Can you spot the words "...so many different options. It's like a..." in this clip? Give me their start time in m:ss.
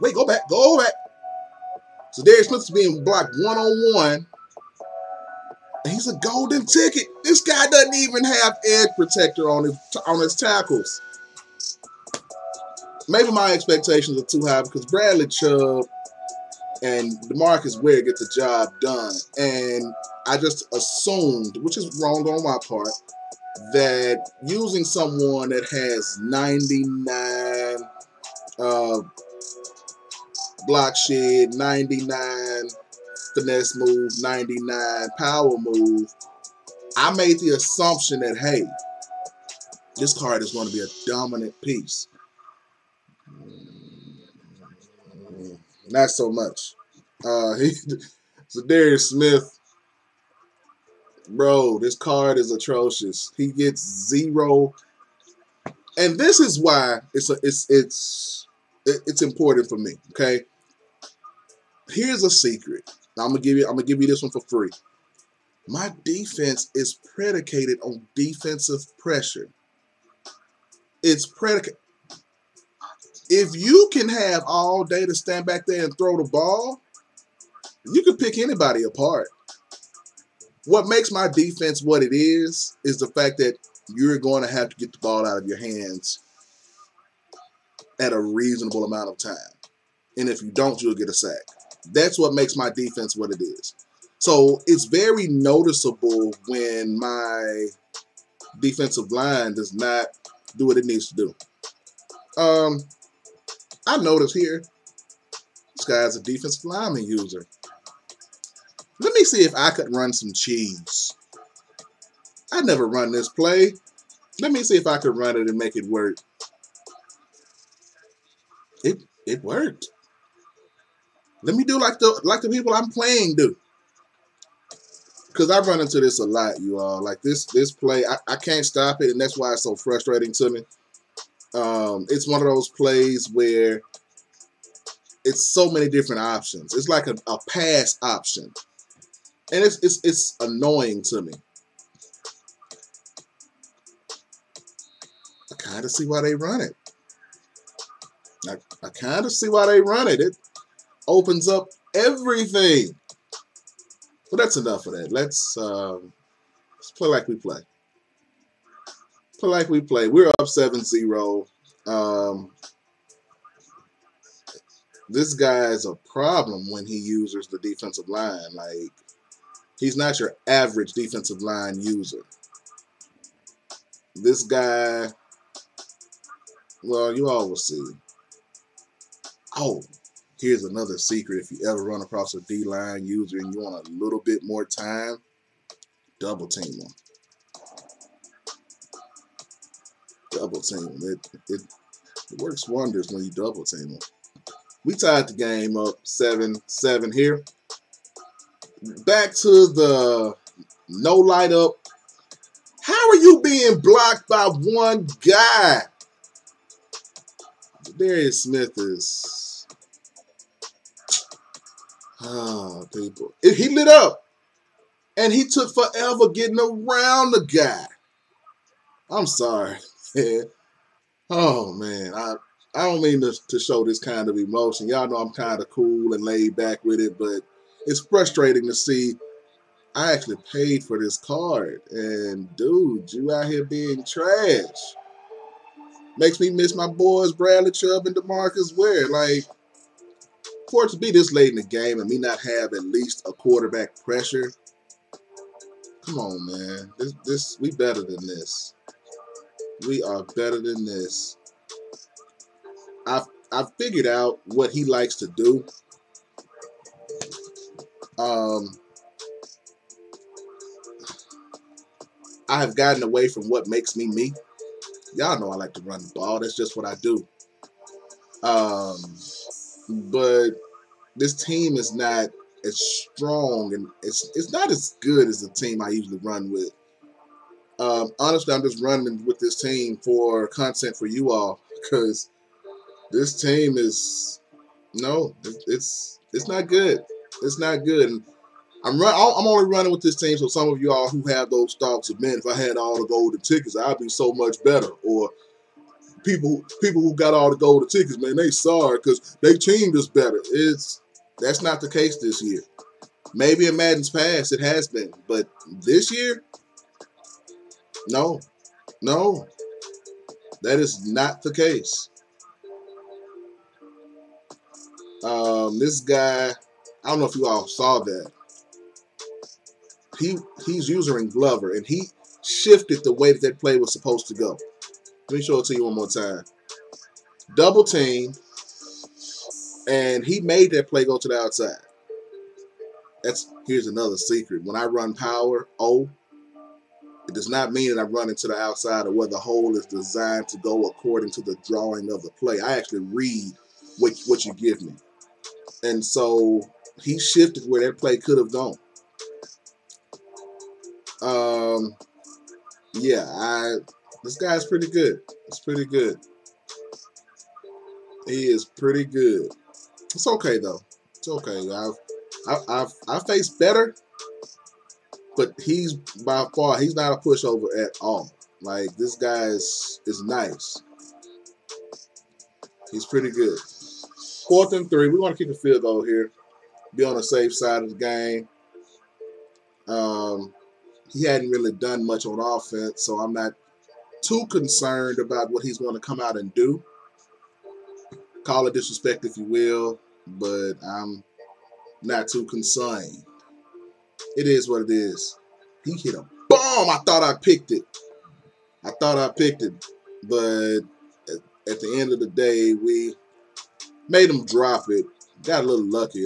2:15.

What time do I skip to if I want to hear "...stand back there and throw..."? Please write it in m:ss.
1:15.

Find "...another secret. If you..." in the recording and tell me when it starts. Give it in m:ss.
3:00.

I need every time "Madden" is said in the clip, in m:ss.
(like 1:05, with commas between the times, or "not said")
5:03.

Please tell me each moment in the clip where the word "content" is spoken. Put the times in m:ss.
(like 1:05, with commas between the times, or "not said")
4:40.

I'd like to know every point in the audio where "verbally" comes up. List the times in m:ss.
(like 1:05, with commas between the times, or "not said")
not said.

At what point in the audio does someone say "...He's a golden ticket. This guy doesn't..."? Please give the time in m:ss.
0:05.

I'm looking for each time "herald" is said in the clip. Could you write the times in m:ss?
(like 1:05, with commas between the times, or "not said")
not said.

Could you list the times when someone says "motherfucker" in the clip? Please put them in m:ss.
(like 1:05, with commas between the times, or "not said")
not said.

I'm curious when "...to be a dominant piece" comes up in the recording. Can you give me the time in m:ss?
0:40.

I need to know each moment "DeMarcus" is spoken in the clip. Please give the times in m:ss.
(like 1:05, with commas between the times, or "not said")
0:17, 3:58.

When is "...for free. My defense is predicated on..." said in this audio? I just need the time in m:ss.
1:04.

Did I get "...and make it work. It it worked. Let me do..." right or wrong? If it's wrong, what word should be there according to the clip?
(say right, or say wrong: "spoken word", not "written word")
right.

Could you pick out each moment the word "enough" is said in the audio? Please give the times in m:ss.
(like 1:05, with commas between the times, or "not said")
2:34.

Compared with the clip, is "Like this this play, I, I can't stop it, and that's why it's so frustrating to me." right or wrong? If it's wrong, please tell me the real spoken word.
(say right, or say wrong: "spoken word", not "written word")
right.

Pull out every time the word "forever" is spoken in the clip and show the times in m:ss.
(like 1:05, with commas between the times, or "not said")
3:35.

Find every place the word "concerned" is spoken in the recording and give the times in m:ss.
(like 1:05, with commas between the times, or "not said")
6:24, 6:32.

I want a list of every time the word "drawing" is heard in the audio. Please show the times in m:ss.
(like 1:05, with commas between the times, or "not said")
5:41.